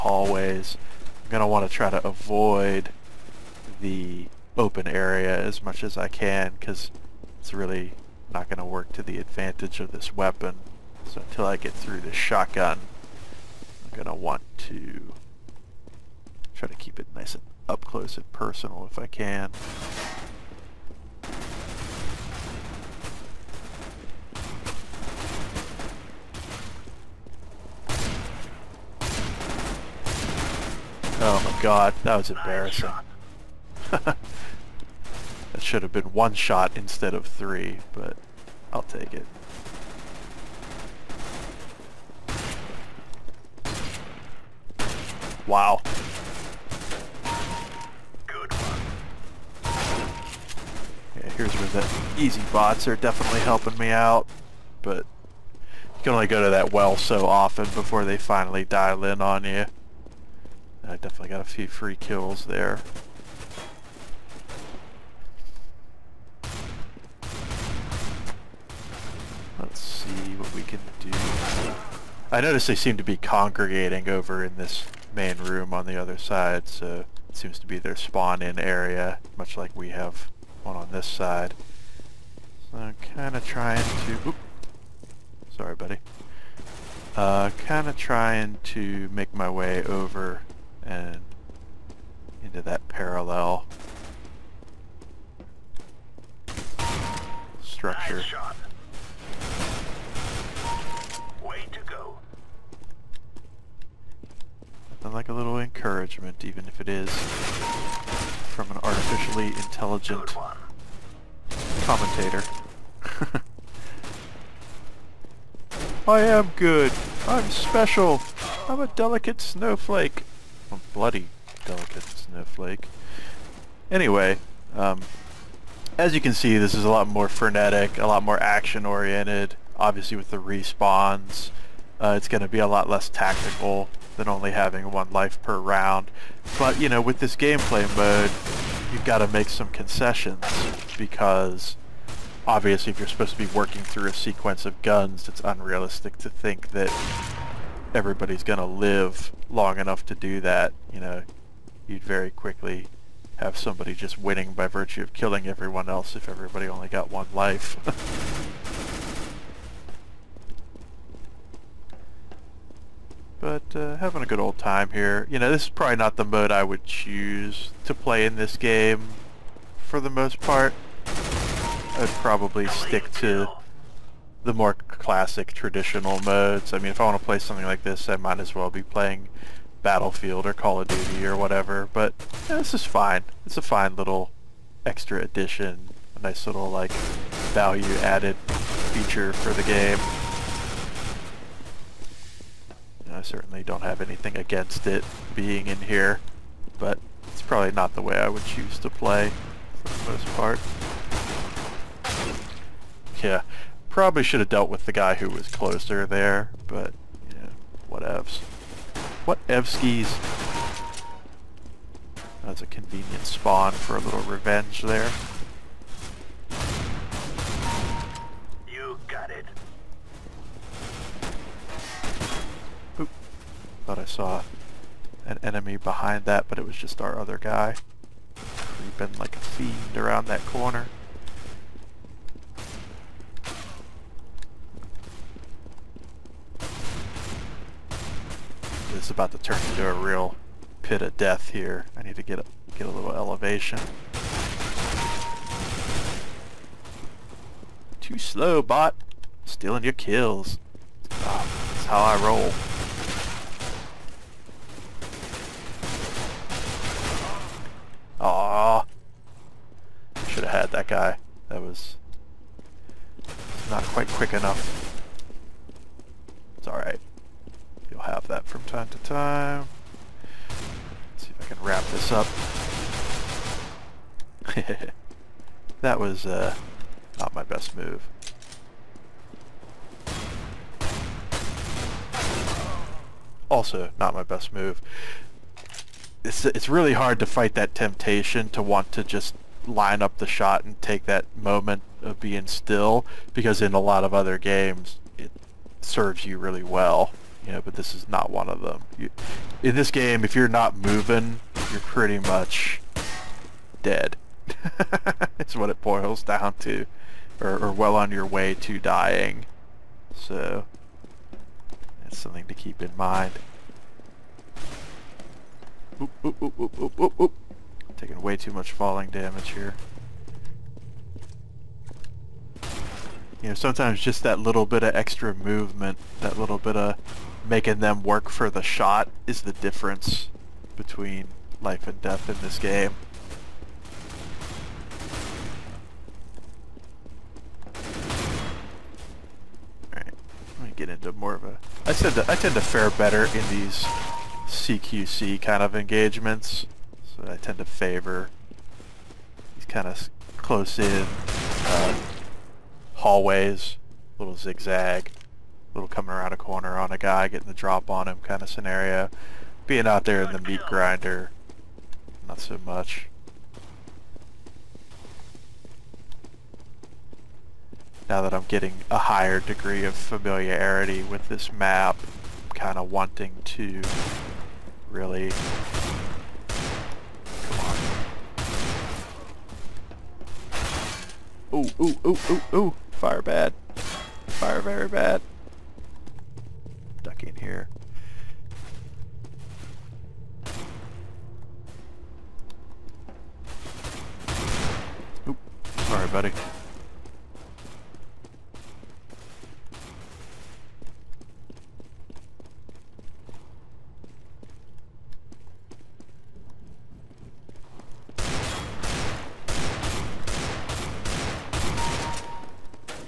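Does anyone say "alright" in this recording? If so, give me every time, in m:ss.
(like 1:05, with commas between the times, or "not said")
4:26, 5:39.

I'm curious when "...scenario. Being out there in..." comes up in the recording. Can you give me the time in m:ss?
5:58.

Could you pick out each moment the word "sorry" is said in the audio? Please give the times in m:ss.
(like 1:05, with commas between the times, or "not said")
1:25, 6:35.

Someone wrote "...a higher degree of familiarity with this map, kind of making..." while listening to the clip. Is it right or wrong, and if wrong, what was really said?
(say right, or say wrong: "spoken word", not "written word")
wrong: "wanting", not "making".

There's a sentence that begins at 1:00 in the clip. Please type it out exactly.
I definitely got a few free kills there.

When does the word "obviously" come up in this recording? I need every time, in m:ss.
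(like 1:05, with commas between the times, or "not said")
2:09, 2:22.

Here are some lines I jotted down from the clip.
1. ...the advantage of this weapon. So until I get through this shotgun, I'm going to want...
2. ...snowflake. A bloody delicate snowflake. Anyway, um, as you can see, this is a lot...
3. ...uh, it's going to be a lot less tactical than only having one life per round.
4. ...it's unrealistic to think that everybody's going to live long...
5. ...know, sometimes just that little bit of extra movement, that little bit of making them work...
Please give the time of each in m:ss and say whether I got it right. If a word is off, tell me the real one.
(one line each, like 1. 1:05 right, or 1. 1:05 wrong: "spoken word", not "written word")
1. 0:09 right
2. 1:59 right
3. 2:11 right
4. 2:25 right
5. 5:23 right.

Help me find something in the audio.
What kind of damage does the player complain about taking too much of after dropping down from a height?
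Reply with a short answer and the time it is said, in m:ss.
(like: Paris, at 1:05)
Falling damage, at 5:18.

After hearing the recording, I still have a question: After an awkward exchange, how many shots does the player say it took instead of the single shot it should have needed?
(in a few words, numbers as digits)
3.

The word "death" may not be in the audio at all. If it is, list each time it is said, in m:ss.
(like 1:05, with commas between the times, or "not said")
4:01, 5:32.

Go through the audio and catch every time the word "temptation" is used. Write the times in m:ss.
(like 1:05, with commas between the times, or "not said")
4:47.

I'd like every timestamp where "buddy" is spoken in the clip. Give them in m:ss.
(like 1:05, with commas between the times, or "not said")
1:25, 6:36.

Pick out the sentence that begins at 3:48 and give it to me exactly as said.
Creeping like a fiend around that corner.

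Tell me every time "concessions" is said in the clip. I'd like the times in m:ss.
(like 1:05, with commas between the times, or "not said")
2:19.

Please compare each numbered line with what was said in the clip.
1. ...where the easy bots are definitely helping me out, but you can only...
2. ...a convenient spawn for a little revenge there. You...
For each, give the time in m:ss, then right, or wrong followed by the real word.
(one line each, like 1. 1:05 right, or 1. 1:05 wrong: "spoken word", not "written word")
1. 0:51 right
2. 3:32 right.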